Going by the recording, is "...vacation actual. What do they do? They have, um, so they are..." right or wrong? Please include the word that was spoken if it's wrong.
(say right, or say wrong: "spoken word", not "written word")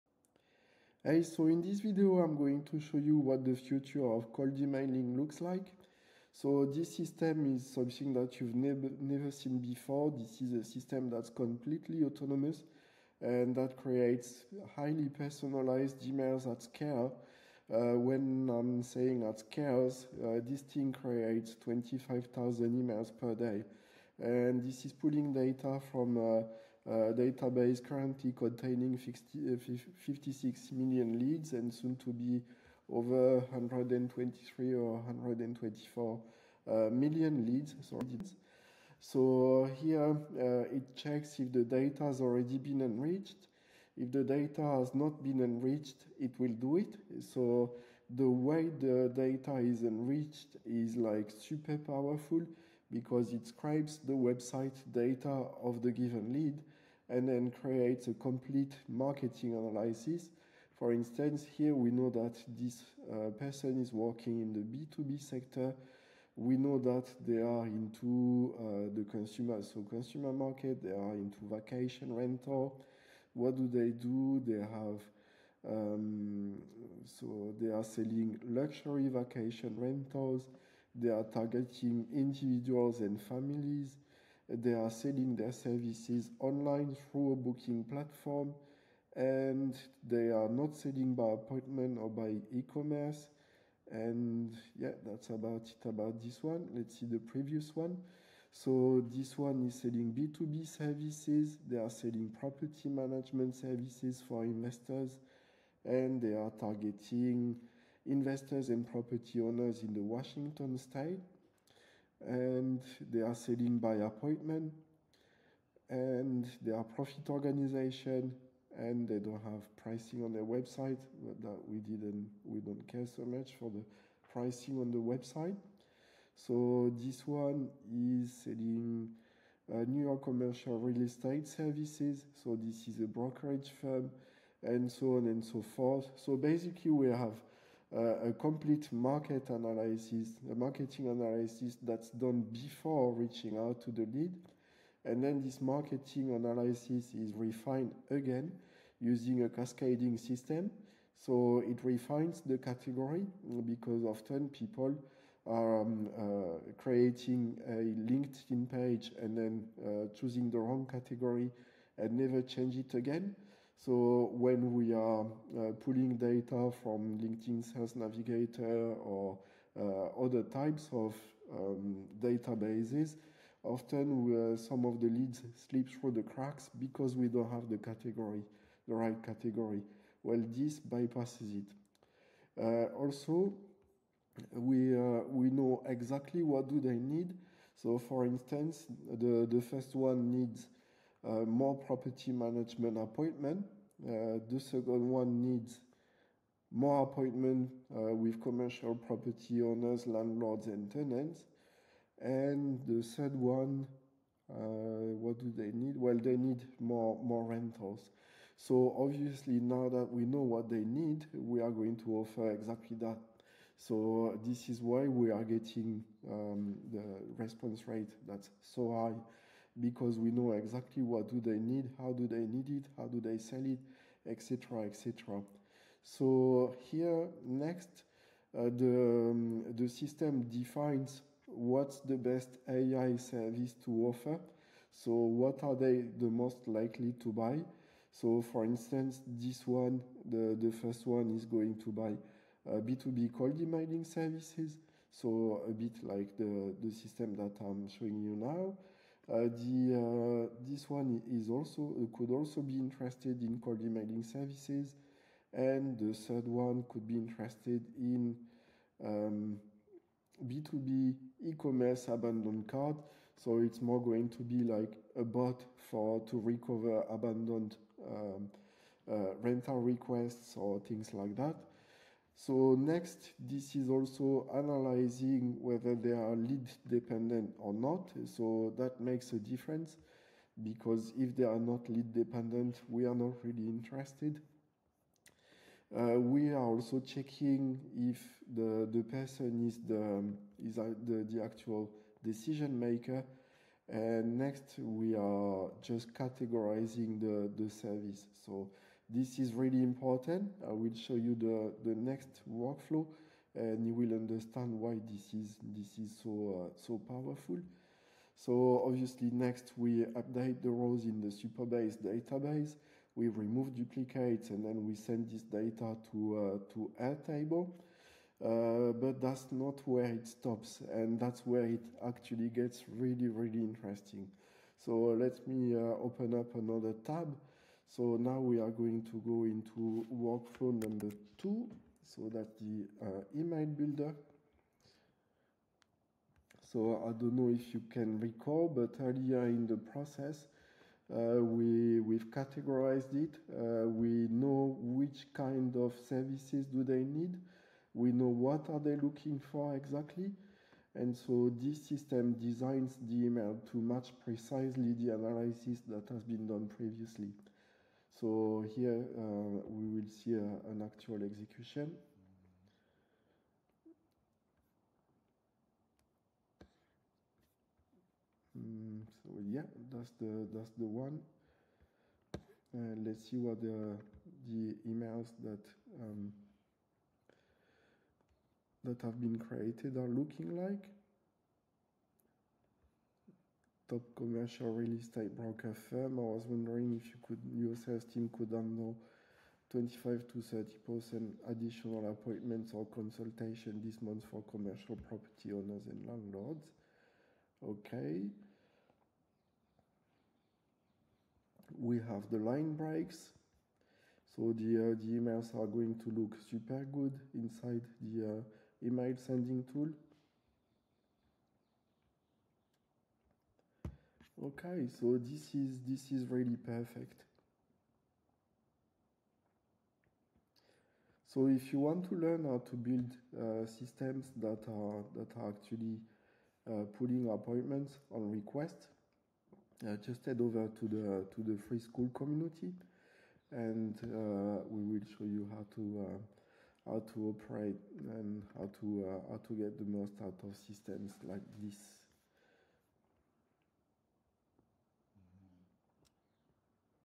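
wrong: "rental", not "actual".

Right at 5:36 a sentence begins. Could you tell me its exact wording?
So I don't know if you can recall, but earlier in the process, uh, we, we've categorized it.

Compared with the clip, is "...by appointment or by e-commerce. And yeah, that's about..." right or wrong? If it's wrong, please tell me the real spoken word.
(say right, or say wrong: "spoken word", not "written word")
right.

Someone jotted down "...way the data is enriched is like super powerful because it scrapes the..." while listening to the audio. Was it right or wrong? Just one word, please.
right.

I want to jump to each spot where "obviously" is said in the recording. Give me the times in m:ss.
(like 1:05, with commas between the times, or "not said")
3:28, 5:08.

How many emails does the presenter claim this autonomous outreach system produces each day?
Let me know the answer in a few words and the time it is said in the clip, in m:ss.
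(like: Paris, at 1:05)
25,000, at 0:21.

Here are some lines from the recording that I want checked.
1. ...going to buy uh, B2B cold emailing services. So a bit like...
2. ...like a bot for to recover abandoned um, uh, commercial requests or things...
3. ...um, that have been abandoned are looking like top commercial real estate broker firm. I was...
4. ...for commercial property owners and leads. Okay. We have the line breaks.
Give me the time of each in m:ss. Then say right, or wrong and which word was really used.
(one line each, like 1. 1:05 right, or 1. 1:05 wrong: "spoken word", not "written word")
1. 4:01 right
2. 4:24 wrong: "rental", not "commercial"
3. 6:16 wrong: "created", not "abandoned"
4. 6:34 wrong: "landlords", not "leads".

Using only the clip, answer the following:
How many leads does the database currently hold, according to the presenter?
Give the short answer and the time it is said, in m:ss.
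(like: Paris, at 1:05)
56 million, at 0:29.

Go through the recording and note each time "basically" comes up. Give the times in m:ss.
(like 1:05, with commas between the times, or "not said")
2:16.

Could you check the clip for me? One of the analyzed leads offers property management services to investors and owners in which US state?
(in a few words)
Washington.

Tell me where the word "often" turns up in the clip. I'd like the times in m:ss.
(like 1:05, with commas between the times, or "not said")
2:34, 2:53.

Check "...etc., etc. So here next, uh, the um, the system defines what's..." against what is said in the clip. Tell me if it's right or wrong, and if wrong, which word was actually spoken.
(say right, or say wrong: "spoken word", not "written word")
right.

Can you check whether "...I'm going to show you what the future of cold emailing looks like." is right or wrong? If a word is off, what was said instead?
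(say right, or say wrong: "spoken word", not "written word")
right.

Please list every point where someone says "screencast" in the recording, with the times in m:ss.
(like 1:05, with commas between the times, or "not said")
not said.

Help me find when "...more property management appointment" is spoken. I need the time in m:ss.
3:11.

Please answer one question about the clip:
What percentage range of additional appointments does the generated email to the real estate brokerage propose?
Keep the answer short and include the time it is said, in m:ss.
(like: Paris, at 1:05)
25 to 30 percent, at 6:29.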